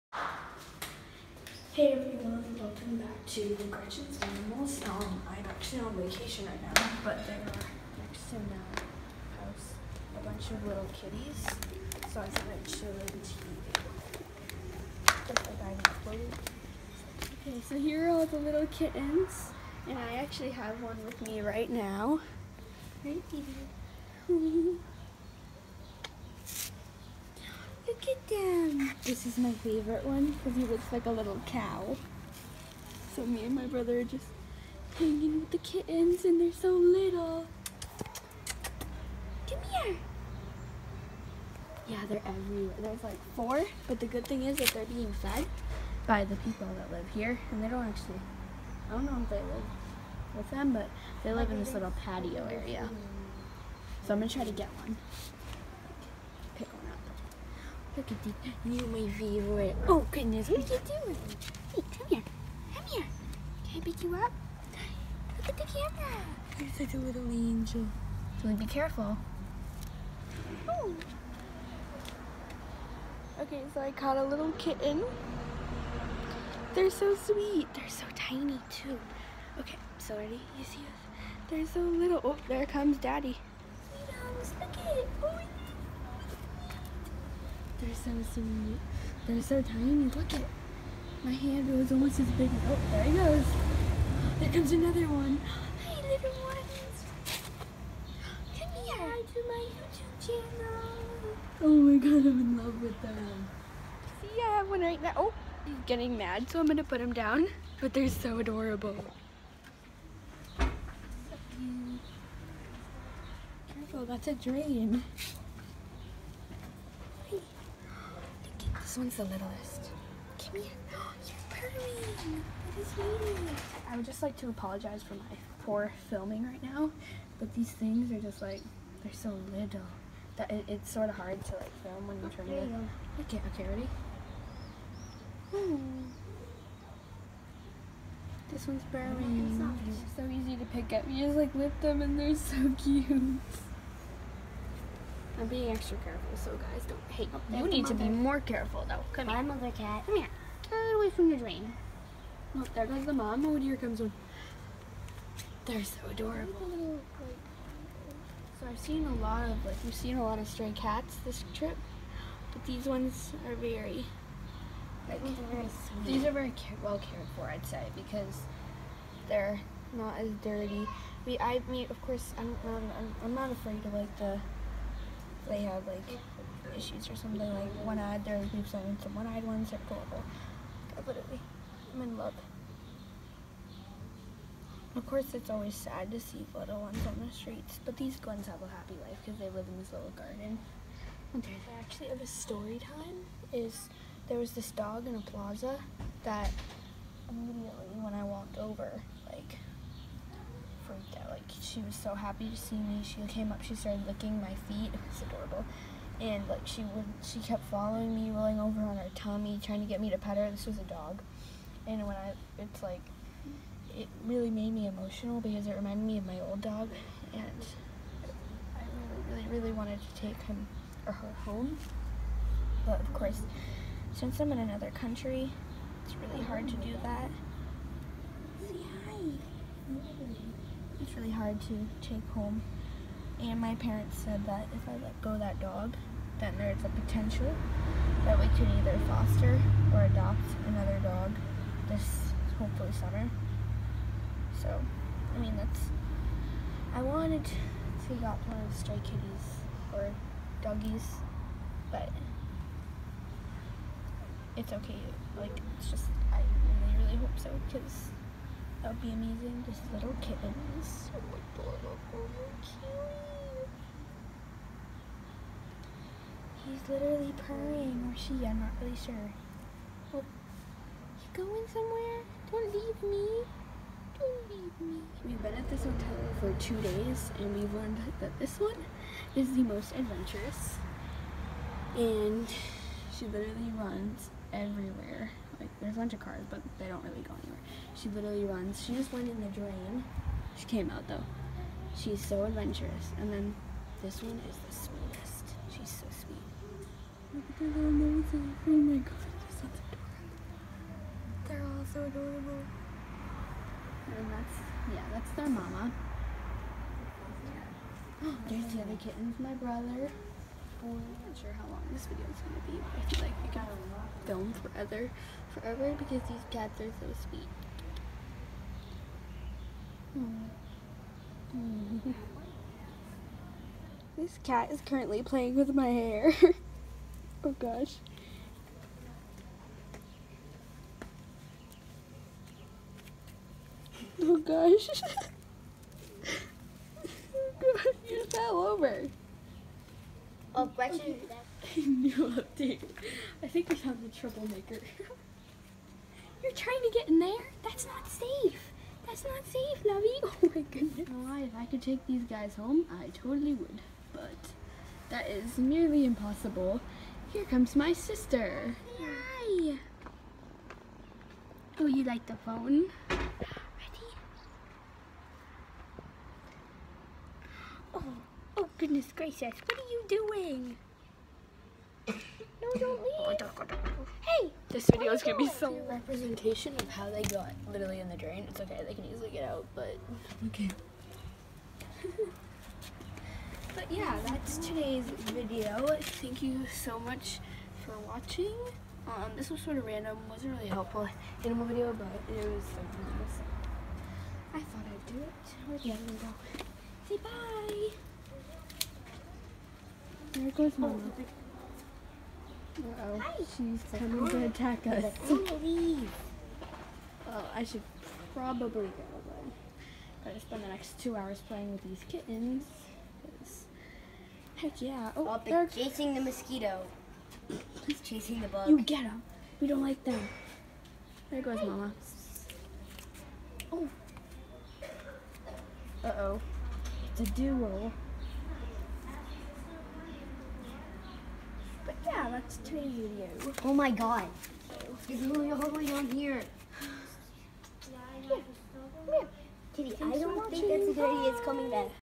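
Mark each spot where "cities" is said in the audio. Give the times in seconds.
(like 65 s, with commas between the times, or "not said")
not said.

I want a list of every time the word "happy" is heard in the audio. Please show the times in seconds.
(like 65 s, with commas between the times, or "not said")
188 s, 202 s.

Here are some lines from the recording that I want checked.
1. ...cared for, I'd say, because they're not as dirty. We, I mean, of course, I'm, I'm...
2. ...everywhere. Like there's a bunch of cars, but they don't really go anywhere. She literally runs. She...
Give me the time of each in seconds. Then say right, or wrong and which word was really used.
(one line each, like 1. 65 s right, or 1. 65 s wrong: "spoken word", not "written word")
1. 166 s right
2. 284 s right.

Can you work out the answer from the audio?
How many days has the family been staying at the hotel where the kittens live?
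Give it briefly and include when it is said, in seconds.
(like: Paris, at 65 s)
2, at 276 s.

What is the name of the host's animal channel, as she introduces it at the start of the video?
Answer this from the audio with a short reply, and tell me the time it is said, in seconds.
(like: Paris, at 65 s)
Gretchen's Animals, at 3 s.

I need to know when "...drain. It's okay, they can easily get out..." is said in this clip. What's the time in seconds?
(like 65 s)
378 s.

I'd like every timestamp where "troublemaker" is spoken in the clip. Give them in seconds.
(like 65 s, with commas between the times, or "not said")
344 s.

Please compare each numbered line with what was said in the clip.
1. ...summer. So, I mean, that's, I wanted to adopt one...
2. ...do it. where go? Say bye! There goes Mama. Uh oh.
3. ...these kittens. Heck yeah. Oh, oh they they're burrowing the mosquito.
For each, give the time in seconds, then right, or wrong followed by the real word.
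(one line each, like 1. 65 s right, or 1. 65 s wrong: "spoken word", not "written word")
1. 242 s right
2. 395 s right
3. 411 s wrong: "chasing", not "burrowing".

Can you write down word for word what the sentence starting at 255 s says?
Like, it's just, I really, really hope so because that would be amazing.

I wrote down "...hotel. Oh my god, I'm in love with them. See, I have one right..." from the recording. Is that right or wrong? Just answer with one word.
wrong.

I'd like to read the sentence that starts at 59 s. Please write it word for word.
Oh goodness, what are you doing?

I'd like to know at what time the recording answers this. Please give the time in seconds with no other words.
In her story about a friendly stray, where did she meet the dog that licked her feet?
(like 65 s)
195 s.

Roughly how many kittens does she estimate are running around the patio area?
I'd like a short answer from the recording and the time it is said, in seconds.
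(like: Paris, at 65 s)
4, at 43 s.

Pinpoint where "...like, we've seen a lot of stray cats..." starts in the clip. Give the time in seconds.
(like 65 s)
159 s.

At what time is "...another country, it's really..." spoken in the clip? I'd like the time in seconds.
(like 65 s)
224 s.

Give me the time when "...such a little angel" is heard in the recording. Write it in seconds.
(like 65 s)
66 s.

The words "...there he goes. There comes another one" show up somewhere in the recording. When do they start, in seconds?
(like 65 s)
92 s.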